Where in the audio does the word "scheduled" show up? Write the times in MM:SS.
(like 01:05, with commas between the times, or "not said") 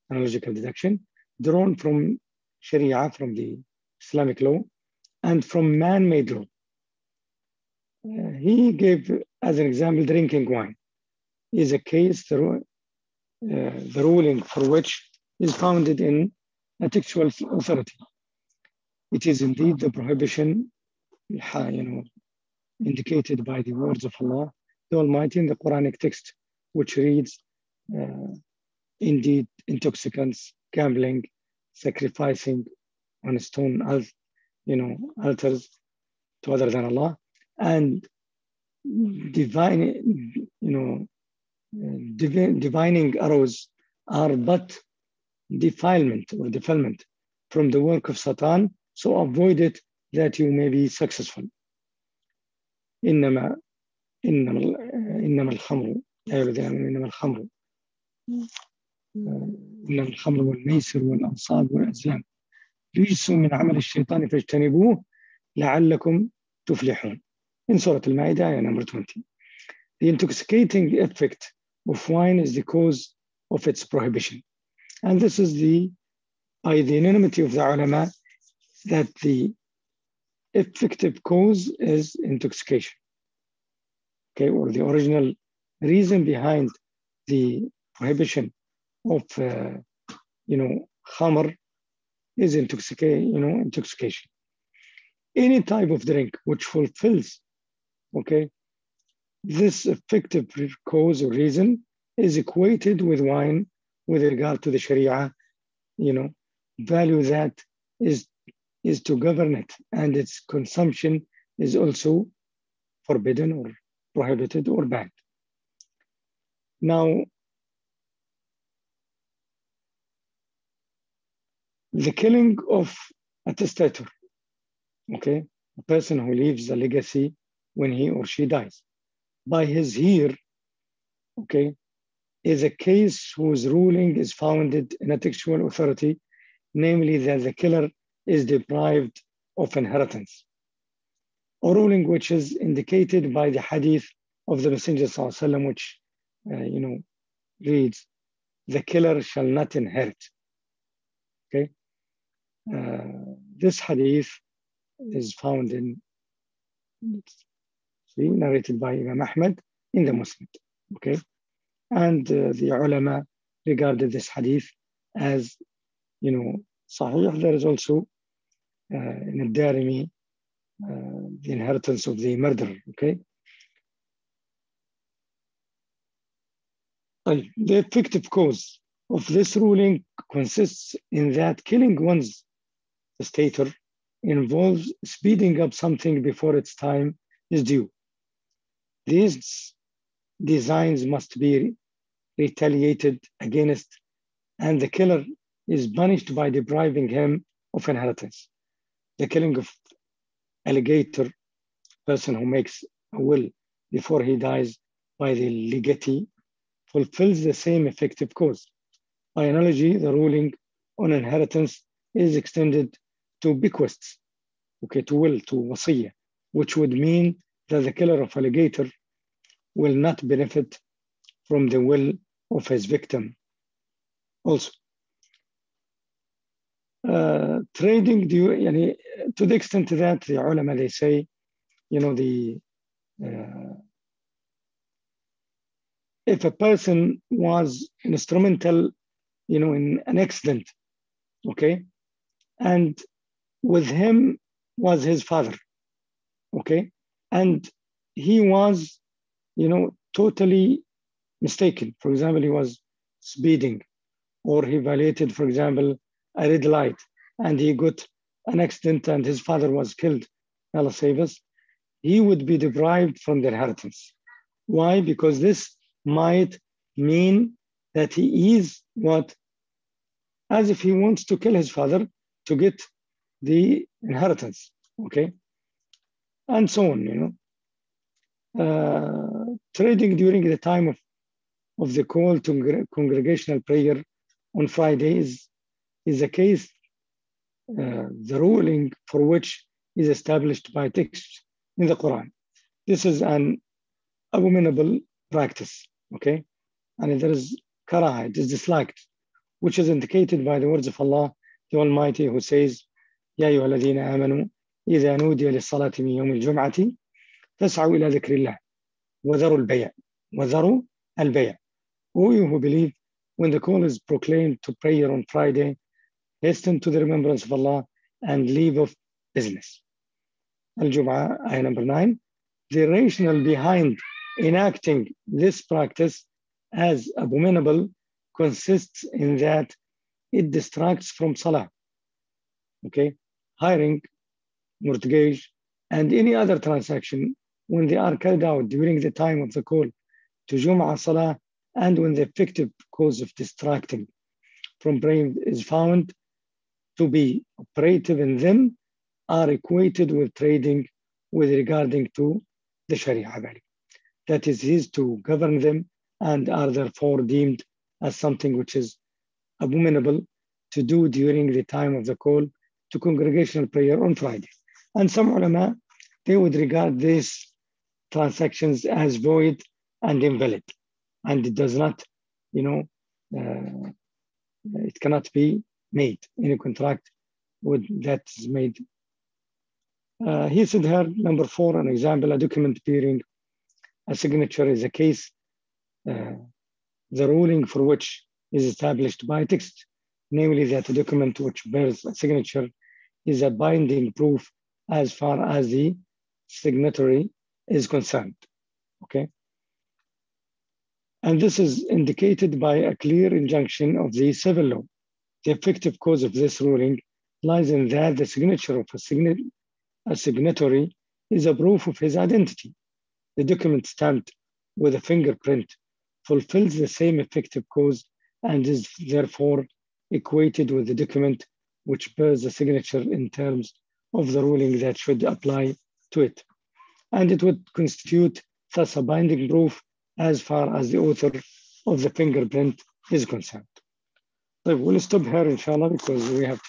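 not said.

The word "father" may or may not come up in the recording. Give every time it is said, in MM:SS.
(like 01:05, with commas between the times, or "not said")
04:05, 04:19, 04:31.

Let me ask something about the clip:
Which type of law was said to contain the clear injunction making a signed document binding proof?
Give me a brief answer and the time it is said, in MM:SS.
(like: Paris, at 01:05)
civil law, at 06:44.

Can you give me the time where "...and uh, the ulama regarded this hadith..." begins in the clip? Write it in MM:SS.
02:41.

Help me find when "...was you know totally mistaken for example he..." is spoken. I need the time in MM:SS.
04:08.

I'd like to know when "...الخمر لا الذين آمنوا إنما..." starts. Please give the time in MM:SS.
00:55.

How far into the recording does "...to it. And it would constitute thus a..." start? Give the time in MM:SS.
07:06.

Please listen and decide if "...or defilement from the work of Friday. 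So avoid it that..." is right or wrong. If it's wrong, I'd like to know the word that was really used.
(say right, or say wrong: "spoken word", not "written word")
wrong: "Satan", not "Friday".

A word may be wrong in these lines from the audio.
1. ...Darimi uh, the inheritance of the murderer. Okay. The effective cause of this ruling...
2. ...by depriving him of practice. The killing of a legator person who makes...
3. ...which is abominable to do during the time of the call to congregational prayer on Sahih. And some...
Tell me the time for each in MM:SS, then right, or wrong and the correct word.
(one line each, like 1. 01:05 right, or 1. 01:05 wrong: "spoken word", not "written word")
1. 02:49 right
2. 03:16 wrong: "inheritance", not "practice"
3. 05:58 wrong: "Friday", not "Sahih".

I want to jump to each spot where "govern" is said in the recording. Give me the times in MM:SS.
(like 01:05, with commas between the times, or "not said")
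01:49, 05:55.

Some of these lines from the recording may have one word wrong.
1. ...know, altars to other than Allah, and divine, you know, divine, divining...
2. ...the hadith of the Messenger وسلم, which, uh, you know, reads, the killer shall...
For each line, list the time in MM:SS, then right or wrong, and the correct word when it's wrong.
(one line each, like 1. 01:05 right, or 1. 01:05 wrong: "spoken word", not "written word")
1. 00:34 right
2. 02:23 right.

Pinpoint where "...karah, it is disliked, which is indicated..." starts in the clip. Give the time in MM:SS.
04:57.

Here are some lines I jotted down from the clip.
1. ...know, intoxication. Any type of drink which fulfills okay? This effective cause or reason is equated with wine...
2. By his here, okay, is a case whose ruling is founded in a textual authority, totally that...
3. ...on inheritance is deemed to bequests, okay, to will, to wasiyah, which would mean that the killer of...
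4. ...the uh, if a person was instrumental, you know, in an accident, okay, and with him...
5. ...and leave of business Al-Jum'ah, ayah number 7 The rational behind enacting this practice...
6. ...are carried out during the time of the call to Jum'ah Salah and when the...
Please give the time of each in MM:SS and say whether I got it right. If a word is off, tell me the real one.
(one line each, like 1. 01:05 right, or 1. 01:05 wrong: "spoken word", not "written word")
1. 01:33 right
2. 02:09 wrong: "namely", not "totally"
3. 03:30 wrong: "extended", not "deemed"
4. 03:52 right
5. 05:18 wrong: "9", not "7"
6. 05:37 right.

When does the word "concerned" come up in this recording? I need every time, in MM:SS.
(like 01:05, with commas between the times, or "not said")
06:37, 07:13.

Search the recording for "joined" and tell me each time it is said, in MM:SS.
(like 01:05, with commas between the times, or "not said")
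not said.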